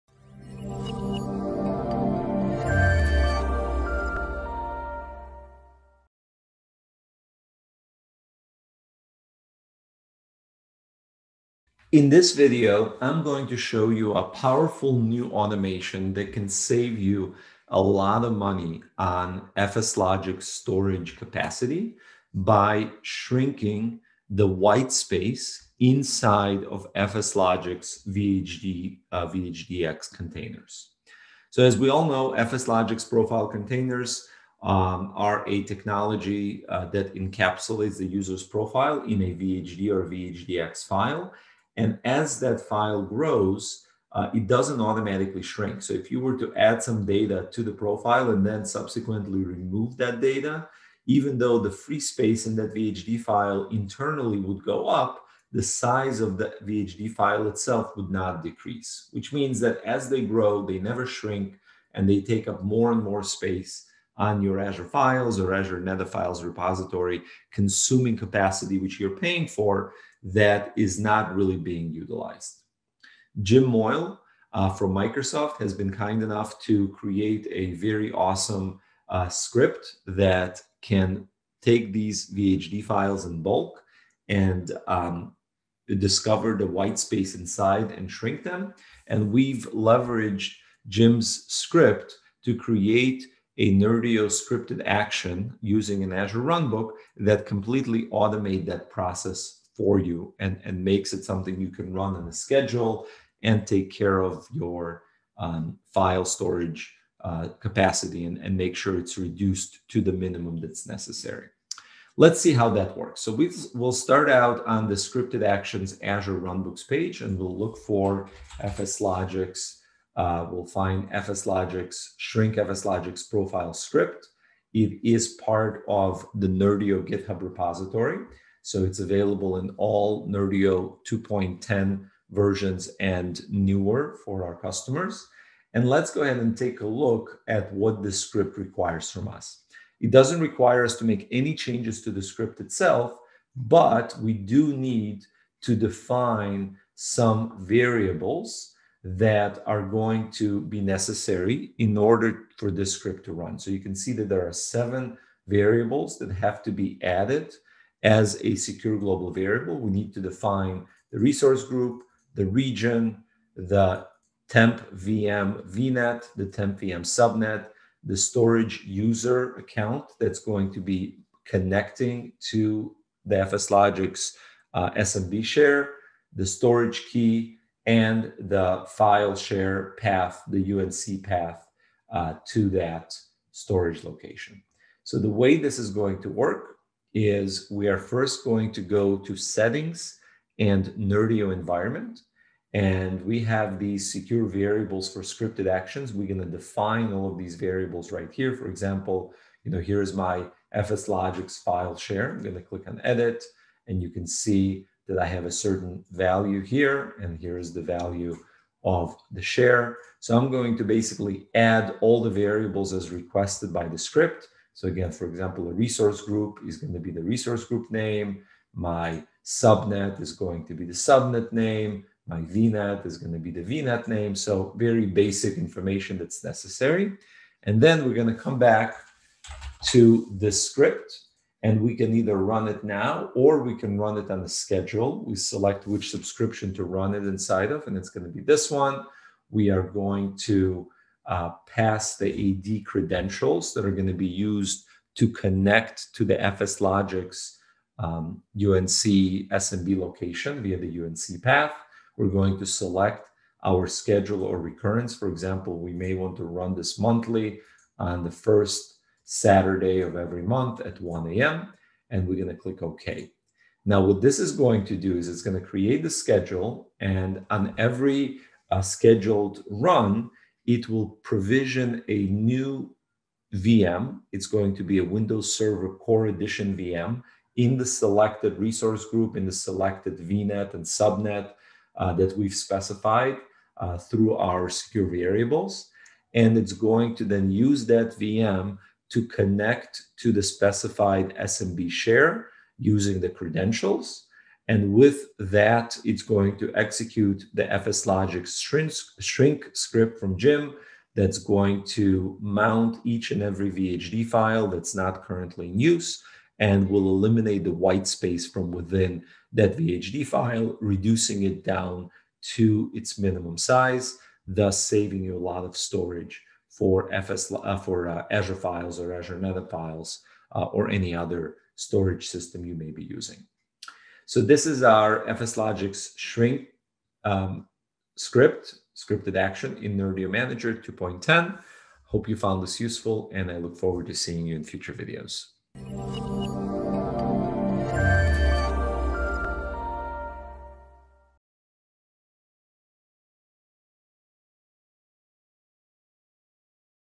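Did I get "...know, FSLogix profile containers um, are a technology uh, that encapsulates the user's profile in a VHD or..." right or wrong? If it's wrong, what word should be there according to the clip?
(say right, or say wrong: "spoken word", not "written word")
right.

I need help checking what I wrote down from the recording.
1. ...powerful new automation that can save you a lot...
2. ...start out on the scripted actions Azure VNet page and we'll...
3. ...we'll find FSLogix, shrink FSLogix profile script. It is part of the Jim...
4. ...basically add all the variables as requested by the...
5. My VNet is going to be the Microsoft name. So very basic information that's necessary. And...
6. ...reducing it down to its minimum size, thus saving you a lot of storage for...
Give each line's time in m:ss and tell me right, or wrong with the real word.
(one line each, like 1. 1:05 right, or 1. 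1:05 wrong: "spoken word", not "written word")
1. 0:14 right
2. 1:53 wrong: "Runbooks", not "VNet"
3. 2:00 wrong: "Nerdio", not "Jim"
4. 3:30 right
5. 3:42 wrong: "VNet", not "Microsoft"
6. 5:10 right.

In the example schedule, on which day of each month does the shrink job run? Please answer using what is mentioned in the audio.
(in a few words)
first Saturday.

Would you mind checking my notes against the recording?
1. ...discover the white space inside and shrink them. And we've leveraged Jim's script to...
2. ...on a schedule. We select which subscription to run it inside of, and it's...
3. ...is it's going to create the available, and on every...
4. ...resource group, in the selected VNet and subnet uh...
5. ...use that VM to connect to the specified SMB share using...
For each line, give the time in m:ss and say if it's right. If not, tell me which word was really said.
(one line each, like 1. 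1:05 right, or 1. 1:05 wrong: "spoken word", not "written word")
1. 1:25 right
2. 3:54 right
3. 4:25 wrong: "schedule", not "available"
4. 4:38 right
5. 4:47 right.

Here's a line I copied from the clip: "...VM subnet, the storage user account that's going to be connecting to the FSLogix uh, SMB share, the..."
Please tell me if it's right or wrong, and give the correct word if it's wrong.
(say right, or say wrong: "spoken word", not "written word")
right.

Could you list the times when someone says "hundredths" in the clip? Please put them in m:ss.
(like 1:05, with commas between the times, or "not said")
not said.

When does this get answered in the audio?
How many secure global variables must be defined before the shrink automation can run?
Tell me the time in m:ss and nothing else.
2:34.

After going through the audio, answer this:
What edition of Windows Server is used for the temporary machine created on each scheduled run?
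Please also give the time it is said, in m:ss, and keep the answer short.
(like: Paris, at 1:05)
Server Core, at 4:35.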